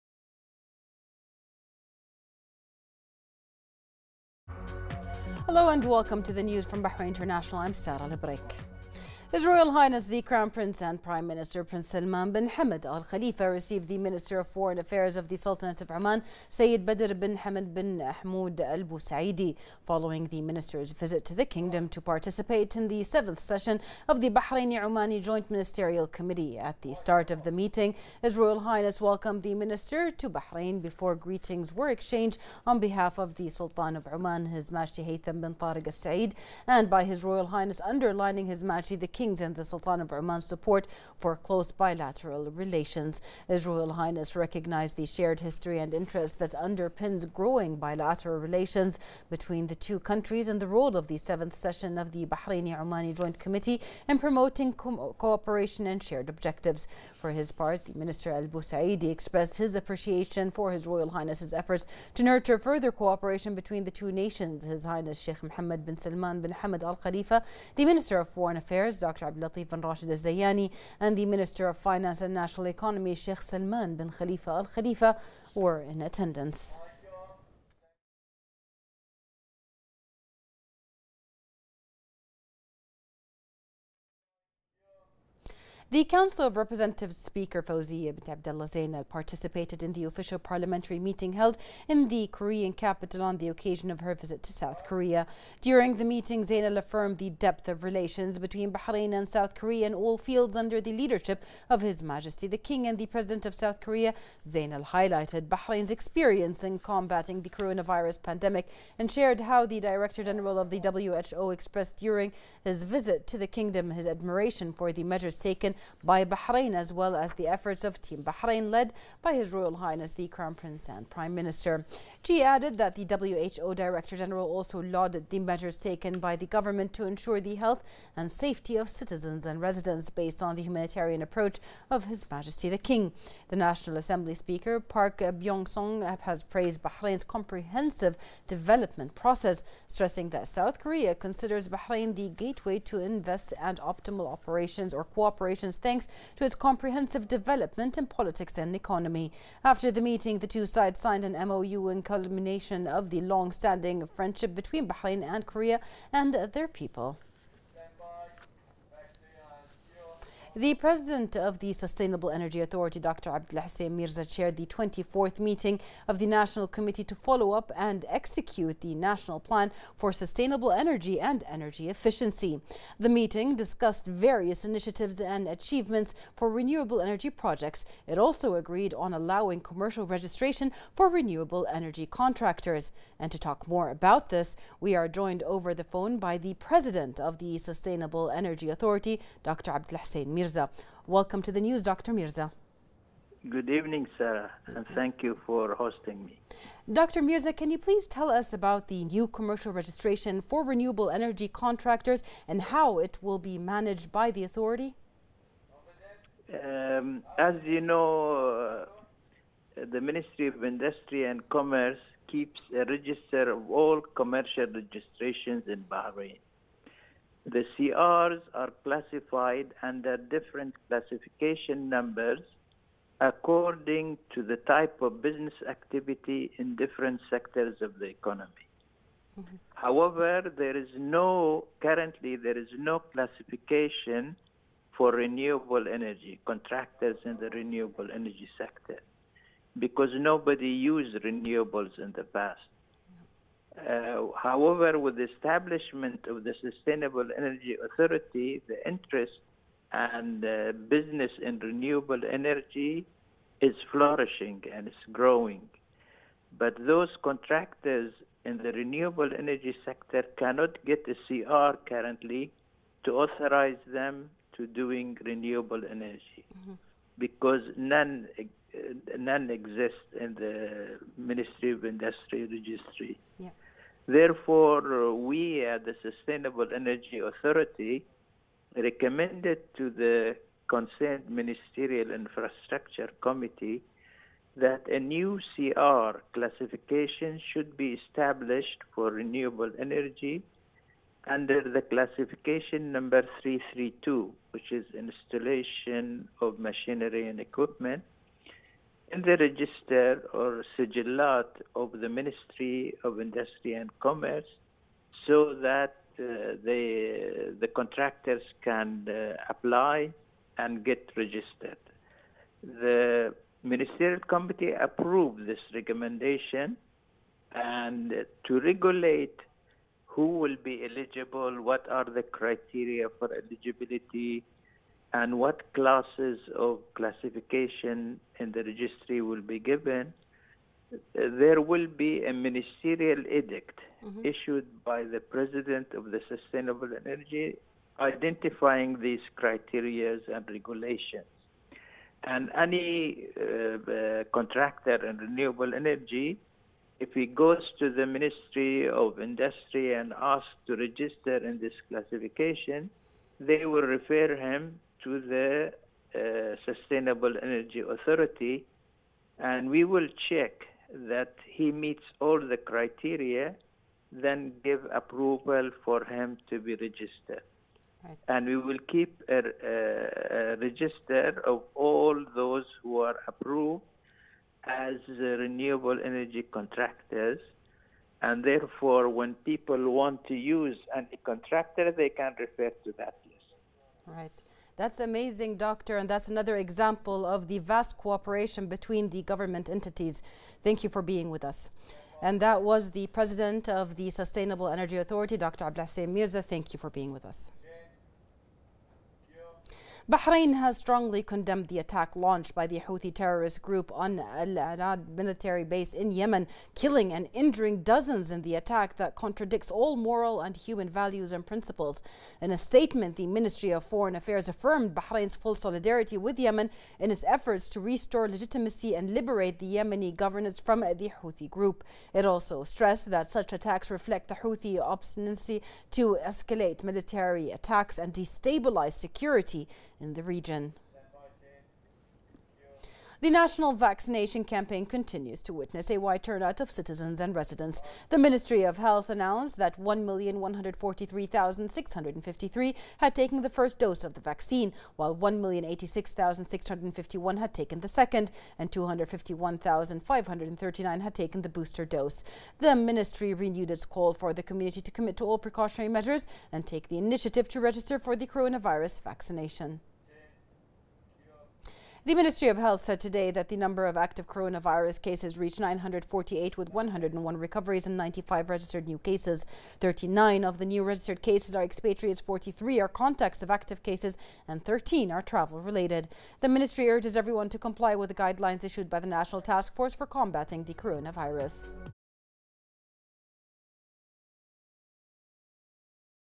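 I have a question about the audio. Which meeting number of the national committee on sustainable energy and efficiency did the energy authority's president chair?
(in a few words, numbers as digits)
24th.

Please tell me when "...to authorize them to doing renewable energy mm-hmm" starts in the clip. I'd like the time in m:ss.
4:23.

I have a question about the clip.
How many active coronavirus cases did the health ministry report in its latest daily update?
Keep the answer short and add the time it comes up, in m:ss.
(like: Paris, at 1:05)
948, at 7:45.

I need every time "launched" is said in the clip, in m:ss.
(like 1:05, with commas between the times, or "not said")
6:42.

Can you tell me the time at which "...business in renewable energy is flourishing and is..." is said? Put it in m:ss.
4:10.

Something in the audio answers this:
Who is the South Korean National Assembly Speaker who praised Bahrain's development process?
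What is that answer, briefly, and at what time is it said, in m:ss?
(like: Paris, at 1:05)
Park Byung-sung, at 2:14.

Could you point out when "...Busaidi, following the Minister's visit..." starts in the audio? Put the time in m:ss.
0:18.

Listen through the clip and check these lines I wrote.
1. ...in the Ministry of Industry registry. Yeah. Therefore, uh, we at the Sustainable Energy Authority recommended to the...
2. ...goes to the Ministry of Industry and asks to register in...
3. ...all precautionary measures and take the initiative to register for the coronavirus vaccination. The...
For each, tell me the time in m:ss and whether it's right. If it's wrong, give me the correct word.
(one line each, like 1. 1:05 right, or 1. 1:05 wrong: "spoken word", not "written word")
1. 4:30 right
2. 5:47 right
3. 7:35 right.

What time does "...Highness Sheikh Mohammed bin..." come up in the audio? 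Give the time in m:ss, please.
1:04.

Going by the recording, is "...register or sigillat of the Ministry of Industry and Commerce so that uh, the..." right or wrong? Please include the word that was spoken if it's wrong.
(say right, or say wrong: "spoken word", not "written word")
right.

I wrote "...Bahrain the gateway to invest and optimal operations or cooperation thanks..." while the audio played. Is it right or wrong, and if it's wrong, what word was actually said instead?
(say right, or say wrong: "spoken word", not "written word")
right.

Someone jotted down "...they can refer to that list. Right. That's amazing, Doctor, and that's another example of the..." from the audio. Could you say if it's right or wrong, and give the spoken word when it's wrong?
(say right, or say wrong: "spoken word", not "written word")
right.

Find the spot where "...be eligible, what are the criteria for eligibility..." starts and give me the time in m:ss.
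5:20.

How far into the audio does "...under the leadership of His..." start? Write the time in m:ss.
1:40.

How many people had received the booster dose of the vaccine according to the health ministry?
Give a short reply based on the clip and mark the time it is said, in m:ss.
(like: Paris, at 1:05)
251,539, at 7:28.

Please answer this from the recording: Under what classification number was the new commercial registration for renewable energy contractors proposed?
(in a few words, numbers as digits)
332.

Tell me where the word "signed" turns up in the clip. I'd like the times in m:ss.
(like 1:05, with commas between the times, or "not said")
2:30.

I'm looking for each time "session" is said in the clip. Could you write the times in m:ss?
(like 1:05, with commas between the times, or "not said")
0:23, 0:51.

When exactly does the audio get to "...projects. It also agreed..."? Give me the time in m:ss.
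2:57.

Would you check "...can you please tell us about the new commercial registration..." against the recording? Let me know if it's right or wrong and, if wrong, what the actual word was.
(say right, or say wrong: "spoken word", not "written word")
right.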